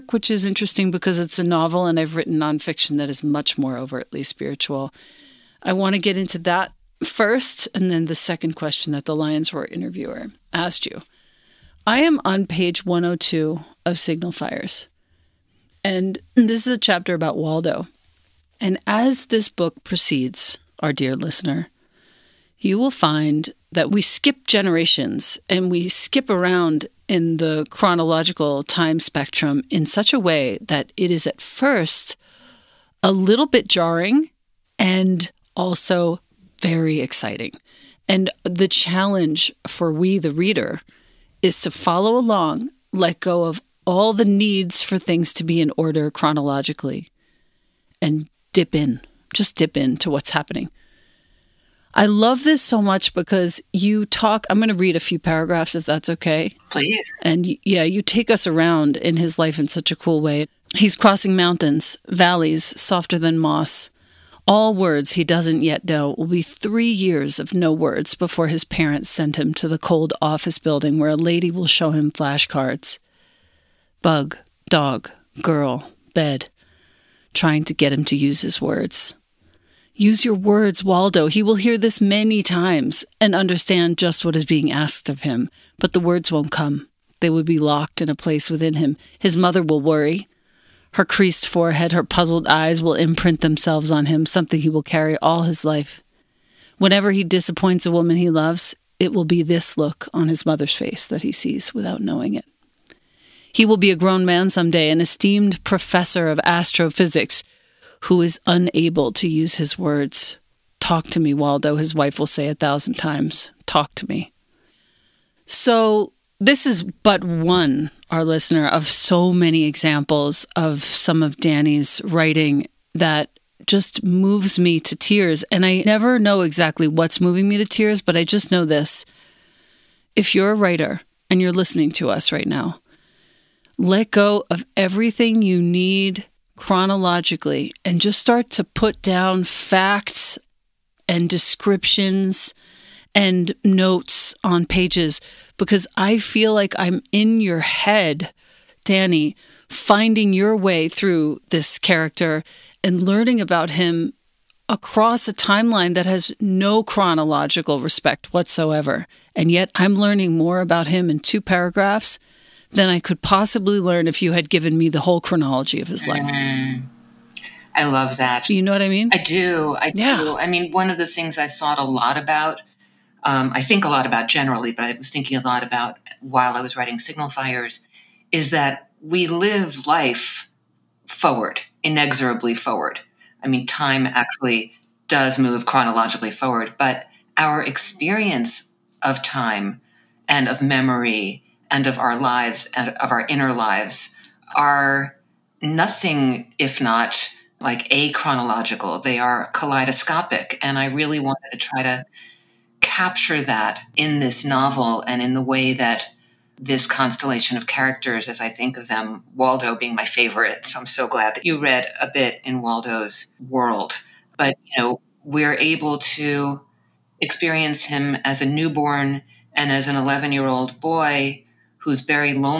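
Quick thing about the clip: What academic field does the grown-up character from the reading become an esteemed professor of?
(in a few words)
astrophysics.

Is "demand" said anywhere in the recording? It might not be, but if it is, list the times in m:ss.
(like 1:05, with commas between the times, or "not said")
not said.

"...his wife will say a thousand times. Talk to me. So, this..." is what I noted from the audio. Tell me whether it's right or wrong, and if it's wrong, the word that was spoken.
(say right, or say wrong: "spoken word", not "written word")
right.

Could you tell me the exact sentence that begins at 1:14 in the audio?
Bug, dog, girl, bed, trying to get him to use his words.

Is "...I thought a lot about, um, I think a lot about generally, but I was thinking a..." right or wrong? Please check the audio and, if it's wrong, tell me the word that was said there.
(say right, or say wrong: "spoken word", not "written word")
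right.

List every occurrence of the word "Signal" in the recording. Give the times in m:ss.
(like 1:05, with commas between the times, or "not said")
0:13, 2:56.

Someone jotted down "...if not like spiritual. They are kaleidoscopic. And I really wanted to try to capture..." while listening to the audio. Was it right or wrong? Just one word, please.
wrong.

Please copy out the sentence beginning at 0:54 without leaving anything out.
I'm going to read a few paragraphs if that's okay.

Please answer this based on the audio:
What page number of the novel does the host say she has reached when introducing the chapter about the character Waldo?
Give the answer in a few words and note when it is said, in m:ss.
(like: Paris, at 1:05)
102, at 0:12.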